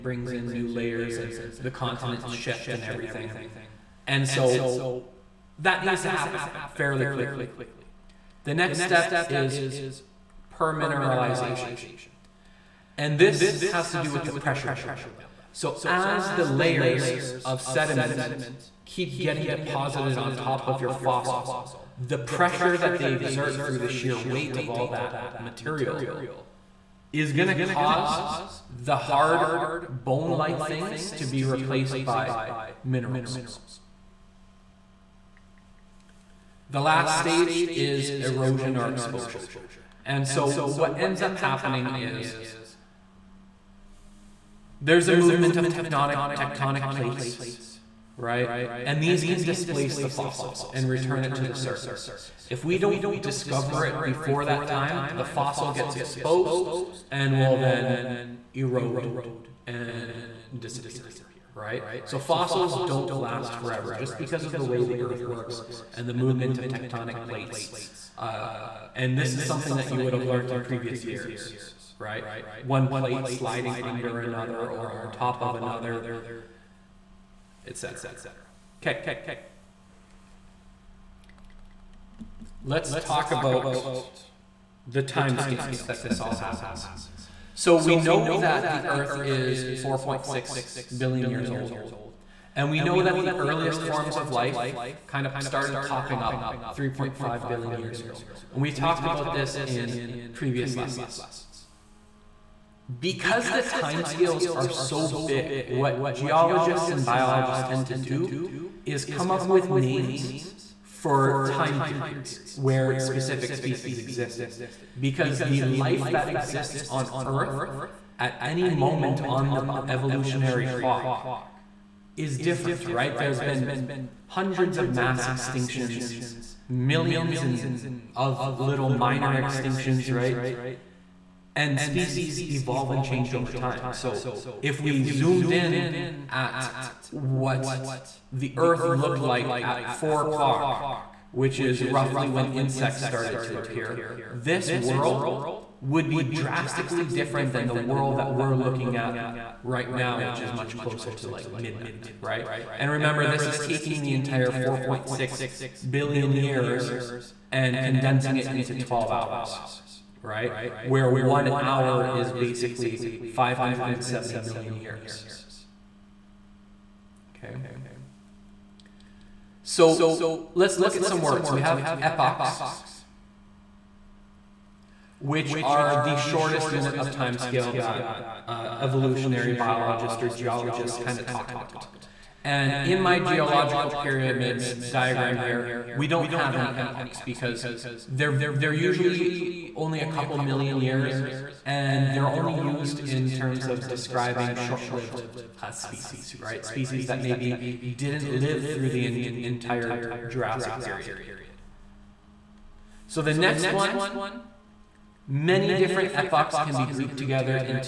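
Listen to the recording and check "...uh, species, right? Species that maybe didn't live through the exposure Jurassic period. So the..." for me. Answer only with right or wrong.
wrong.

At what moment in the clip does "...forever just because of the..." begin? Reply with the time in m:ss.
1:03.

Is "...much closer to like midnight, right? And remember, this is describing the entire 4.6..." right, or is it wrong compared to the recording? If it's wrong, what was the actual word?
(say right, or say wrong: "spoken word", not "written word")
wrong: "taking", not "describing".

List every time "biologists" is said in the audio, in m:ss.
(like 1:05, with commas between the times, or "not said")
1:47, 2:59.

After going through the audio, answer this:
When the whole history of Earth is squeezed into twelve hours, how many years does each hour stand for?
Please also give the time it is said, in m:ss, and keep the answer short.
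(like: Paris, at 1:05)
570 million years, at 2:43.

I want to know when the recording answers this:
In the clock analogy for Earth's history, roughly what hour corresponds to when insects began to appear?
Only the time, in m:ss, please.
2:19.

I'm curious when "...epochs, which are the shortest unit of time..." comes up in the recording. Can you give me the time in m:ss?
2:52.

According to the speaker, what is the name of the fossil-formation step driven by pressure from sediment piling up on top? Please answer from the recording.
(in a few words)
Permineralization.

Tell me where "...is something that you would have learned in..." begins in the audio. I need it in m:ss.
1:09.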